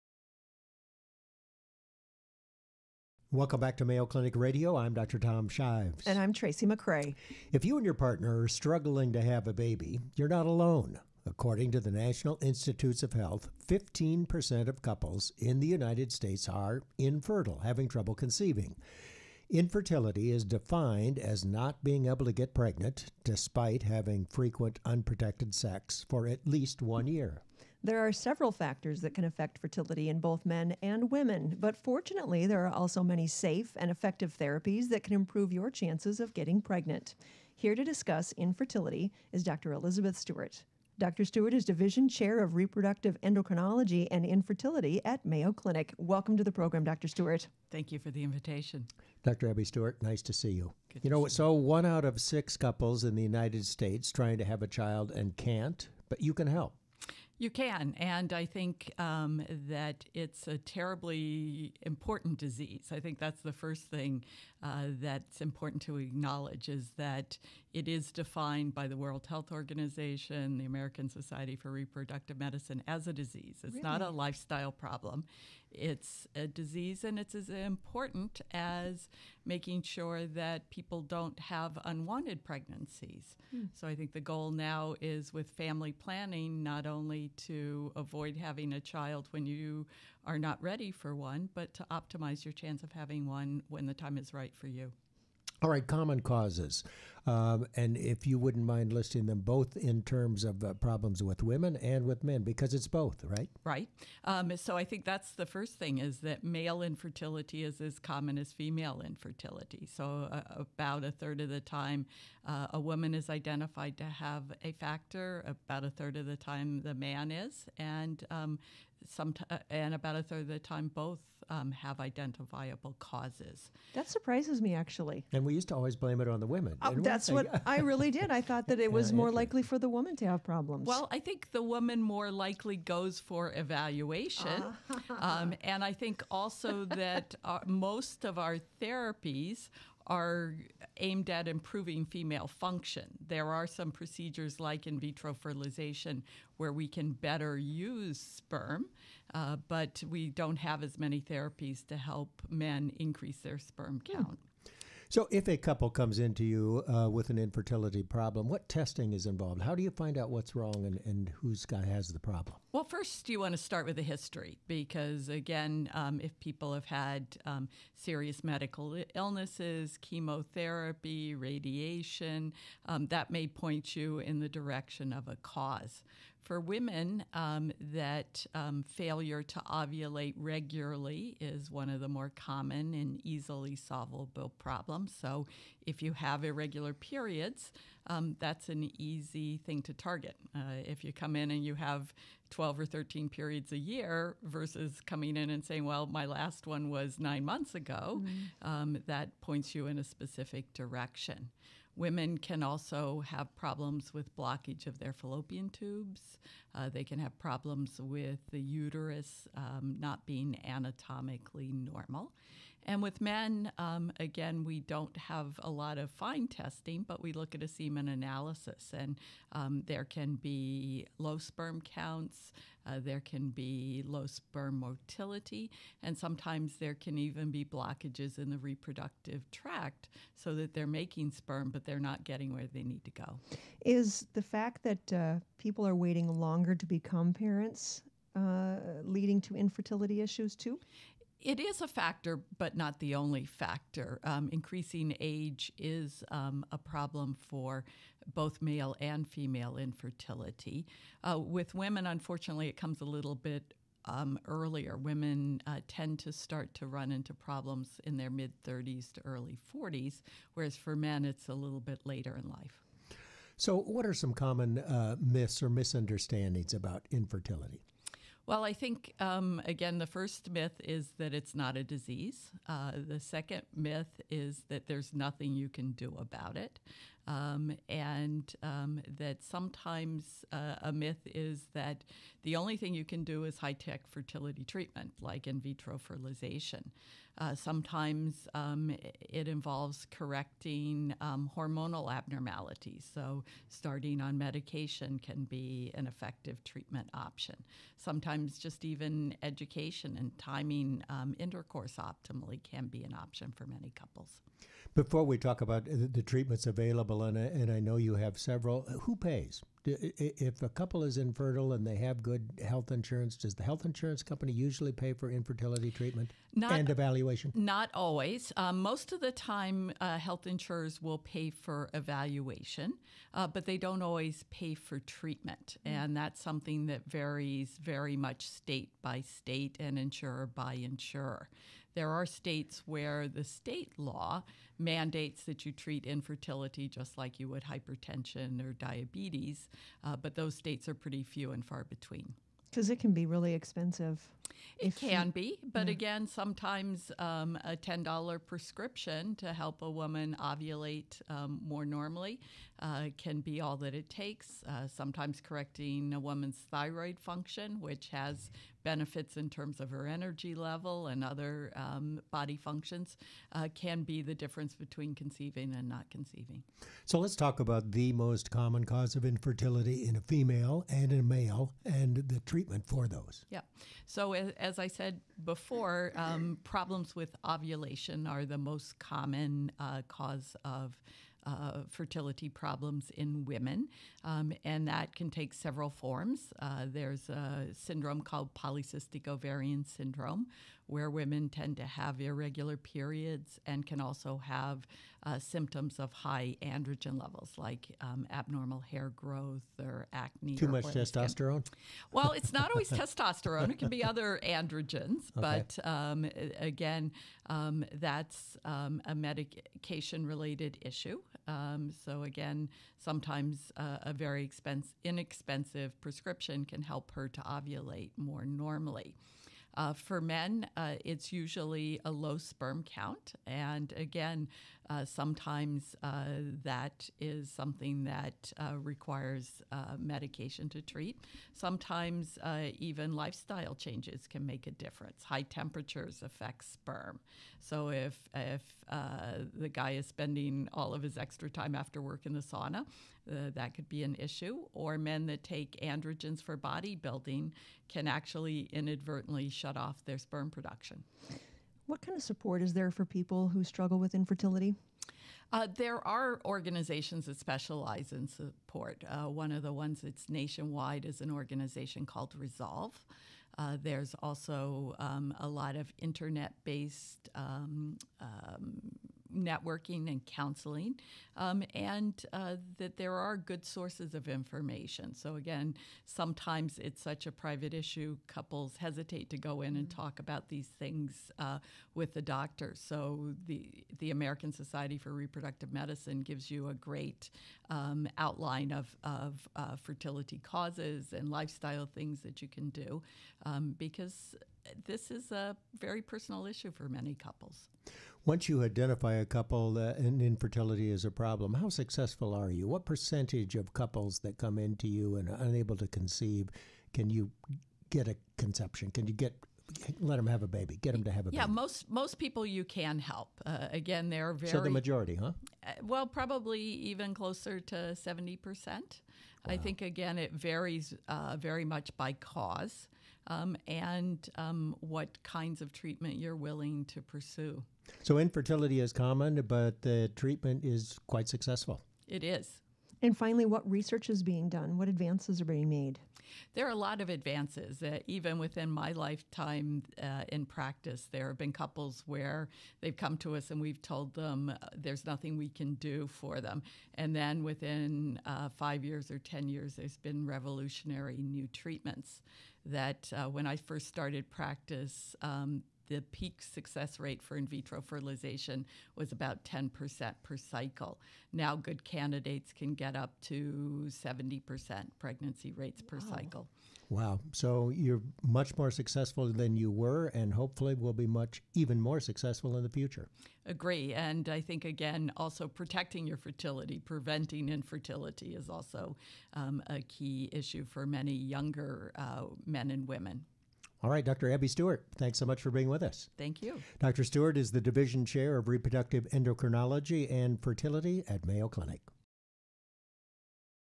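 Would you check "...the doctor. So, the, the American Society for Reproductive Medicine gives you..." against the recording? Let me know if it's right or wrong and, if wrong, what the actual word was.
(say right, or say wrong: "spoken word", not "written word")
right.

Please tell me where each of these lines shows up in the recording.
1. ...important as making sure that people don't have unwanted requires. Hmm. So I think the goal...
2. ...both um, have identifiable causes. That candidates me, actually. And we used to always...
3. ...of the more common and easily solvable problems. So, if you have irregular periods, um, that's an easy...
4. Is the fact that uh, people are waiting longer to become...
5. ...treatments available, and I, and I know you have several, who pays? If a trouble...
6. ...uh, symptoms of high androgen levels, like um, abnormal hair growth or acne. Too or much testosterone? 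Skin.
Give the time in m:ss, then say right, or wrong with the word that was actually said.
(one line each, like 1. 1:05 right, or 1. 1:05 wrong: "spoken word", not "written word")
1. 1:17 wrong: "pregnancies", not "requires"
2. 2:00 wrong: "surprises", not "candidates"
3. 3:01 right
4. 3:53 right
5. 5:06 wrong: "couple", not "trouble"
6. 6:35 right.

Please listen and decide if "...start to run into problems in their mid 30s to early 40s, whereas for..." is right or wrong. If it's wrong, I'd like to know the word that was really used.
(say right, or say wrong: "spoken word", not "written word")
right.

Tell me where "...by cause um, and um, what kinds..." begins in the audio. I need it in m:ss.
8:41.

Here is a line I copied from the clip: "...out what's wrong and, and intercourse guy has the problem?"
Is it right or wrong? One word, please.
wrong.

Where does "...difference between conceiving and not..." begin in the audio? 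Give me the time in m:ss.
6:04.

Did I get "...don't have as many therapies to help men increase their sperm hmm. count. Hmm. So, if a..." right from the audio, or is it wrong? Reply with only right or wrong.
right.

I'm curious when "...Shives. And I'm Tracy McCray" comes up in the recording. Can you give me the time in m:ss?
0:05.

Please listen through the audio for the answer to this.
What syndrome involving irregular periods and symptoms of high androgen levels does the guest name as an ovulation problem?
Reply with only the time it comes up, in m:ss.
6:28.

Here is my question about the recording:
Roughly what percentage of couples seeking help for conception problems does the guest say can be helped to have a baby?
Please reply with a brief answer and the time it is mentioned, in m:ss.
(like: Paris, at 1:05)
70 percent, at 8:37.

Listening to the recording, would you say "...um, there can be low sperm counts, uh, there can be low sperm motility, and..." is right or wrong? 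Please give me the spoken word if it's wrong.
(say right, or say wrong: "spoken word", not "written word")
right.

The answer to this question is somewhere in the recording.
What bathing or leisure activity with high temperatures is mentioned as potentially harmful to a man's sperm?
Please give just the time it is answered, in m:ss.
7:22.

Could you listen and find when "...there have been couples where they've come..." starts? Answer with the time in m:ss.
9:01.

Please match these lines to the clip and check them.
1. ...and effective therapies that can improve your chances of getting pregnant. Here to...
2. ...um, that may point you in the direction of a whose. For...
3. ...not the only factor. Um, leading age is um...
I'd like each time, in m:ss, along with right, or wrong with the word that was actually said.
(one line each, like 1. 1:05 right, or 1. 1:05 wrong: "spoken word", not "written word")
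1. 0:33 right
2. 2:52 wrong: "cause", not "whose"
3. 4:02 wrong: "increasing", not "leading".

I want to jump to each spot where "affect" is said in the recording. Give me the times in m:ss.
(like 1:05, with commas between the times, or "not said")
0:29, 7:16.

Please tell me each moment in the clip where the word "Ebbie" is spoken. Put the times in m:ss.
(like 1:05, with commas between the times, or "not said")
0:49, 9:44.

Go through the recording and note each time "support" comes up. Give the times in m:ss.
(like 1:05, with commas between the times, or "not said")
7:32, 7:38.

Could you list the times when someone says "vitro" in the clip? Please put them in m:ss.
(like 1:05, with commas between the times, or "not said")
2:24, 4:45, 9:17.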